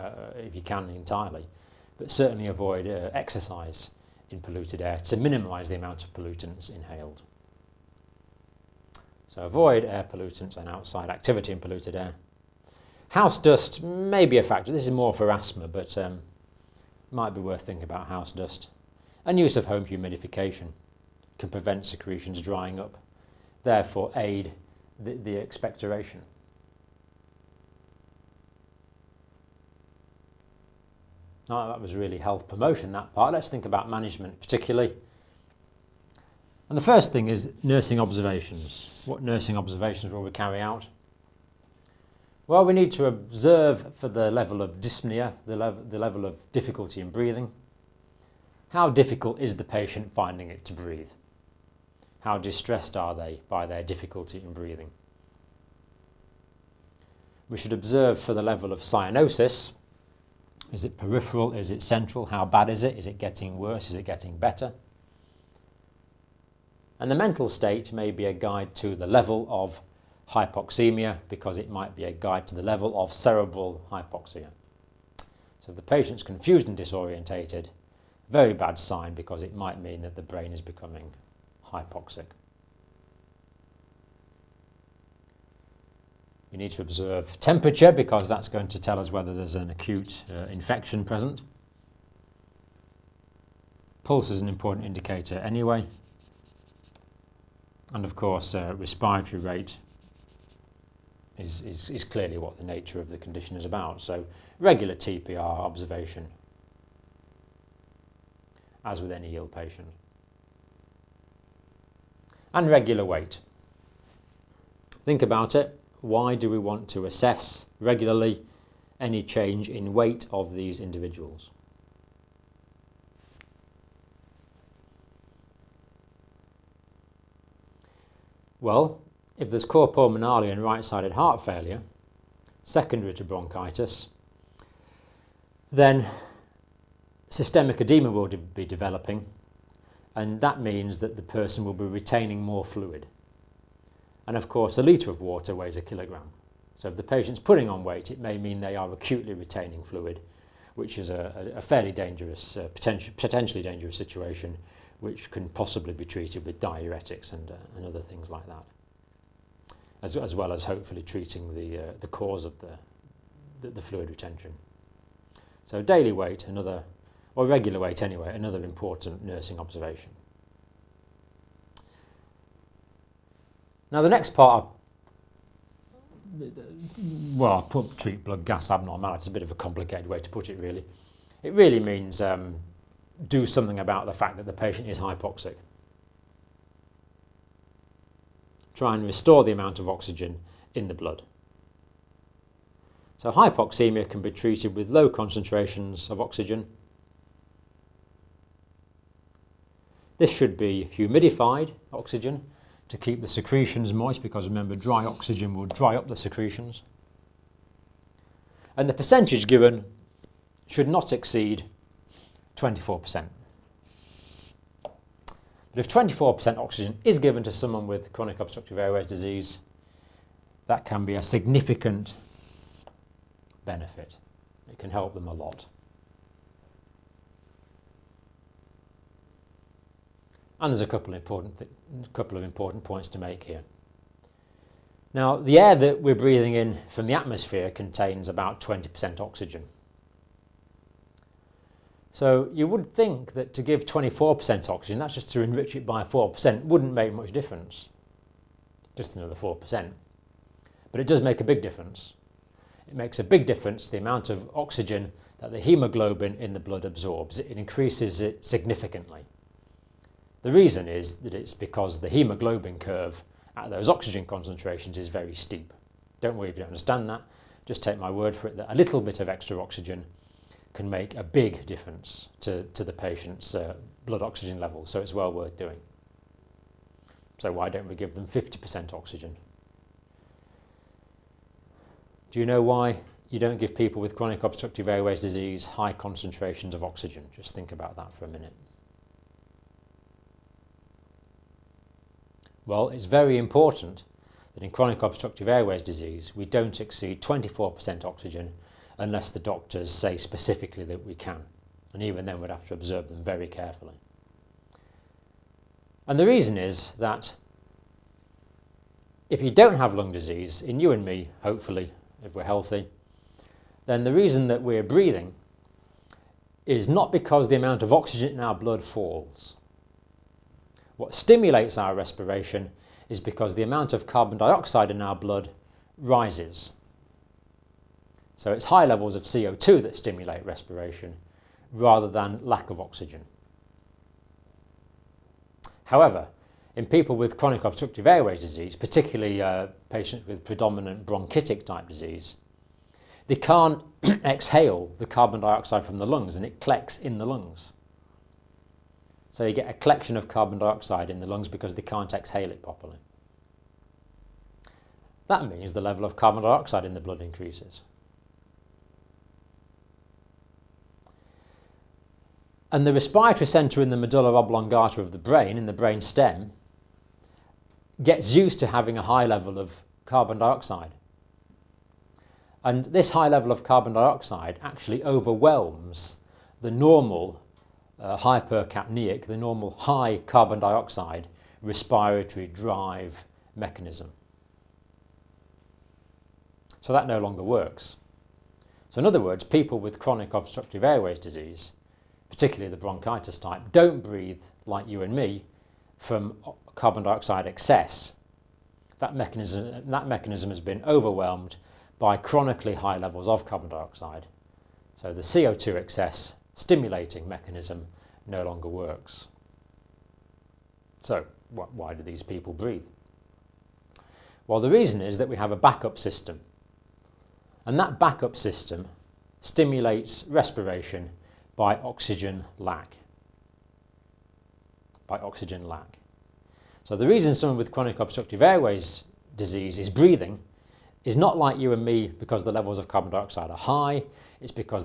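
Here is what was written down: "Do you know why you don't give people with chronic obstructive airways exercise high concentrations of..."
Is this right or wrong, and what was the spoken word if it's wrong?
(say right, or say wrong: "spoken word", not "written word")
wrong: "disease", not "exercise".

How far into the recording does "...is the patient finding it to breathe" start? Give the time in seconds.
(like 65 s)
49 s.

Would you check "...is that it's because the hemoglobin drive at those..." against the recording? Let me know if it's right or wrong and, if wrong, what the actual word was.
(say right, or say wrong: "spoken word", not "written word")
wrong: "curve", not "drive".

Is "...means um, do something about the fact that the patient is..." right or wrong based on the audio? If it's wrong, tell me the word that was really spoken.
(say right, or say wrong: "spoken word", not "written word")
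right.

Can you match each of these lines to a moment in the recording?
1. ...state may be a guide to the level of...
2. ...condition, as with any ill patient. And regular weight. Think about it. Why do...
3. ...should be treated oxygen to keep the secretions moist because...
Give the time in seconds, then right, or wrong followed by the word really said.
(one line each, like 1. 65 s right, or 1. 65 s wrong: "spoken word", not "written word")
1. 67 s right
2. 105 s wrong: "observation", not "condition"
3. 200 s wrong: "humidified", not "treated".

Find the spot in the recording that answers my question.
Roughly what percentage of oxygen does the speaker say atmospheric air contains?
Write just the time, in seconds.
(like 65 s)
238 s.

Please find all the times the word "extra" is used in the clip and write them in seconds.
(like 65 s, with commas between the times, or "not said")
269 s.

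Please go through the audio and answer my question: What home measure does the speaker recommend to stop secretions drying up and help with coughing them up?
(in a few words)
Home humidification.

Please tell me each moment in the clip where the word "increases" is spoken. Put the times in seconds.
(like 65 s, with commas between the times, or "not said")
257 s, 357 s.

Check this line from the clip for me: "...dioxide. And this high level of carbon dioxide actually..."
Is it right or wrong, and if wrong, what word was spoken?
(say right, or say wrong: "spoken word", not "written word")
right.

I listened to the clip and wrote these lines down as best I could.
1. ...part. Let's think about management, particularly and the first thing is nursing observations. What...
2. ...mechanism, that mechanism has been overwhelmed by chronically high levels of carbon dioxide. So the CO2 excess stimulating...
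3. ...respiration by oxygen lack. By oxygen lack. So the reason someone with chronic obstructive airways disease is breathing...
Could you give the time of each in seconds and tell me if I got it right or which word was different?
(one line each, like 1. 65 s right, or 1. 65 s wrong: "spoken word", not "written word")
1. 33 s right
2. 399 s right
3. 420 s right.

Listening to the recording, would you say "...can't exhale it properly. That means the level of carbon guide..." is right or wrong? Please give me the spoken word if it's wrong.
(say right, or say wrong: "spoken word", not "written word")
wrong: "dioxide", not "guide".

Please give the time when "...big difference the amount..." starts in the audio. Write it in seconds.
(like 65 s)
253 s.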